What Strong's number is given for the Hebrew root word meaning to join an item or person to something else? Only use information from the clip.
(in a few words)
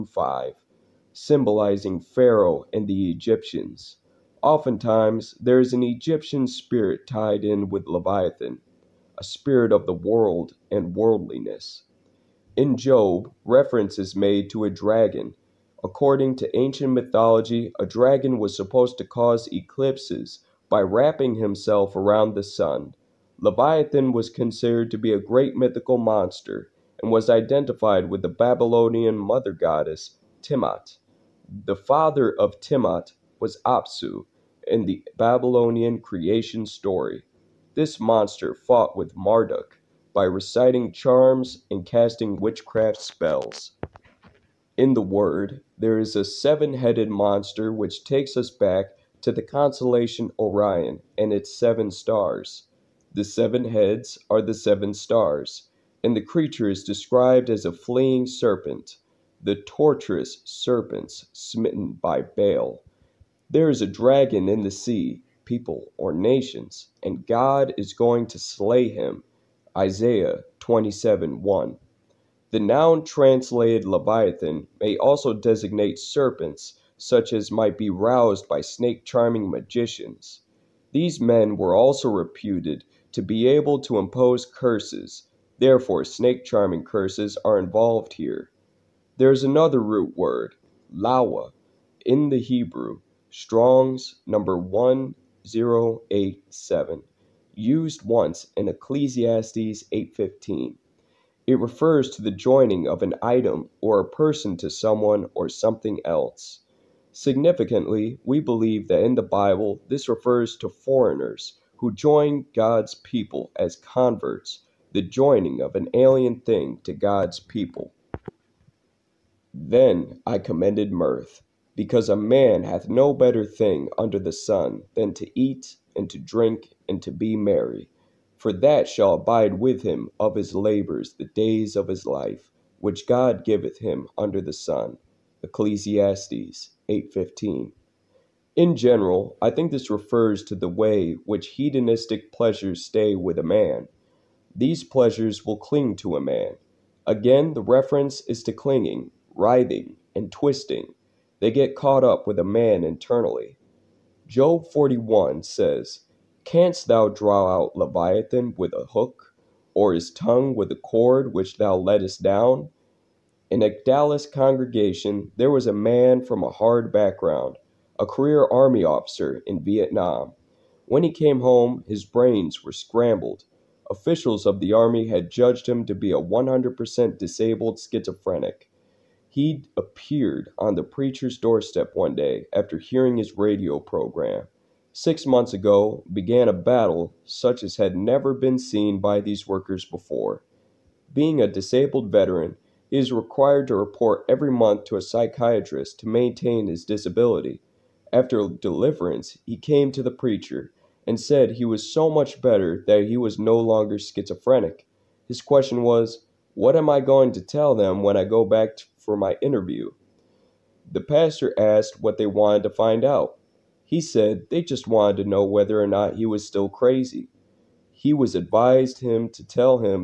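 1087.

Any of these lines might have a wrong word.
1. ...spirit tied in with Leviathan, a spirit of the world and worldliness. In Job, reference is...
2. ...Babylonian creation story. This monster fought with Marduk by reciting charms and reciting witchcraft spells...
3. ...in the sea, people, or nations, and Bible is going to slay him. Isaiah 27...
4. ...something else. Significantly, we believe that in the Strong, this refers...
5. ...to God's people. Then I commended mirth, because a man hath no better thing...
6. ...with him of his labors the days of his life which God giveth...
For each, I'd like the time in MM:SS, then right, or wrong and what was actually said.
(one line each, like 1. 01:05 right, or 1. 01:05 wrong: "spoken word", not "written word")
1. 00:06 right
2. 00:35 wrong: "casting", not "reciting"
3. 01:04 wrong: "God", not "Bible"
4. 01:45 wrong: "Bible", not "Strong"
5. 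01:56 right
6. 02:09 right.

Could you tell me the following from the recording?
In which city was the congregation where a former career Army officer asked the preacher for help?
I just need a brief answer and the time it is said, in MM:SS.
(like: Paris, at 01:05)
Dallas, at 02:43.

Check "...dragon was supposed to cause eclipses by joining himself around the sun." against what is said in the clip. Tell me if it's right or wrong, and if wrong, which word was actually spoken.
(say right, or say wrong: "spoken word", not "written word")
wrong: "wrapping", not "joining".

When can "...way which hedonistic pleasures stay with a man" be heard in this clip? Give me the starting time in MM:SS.
02:20.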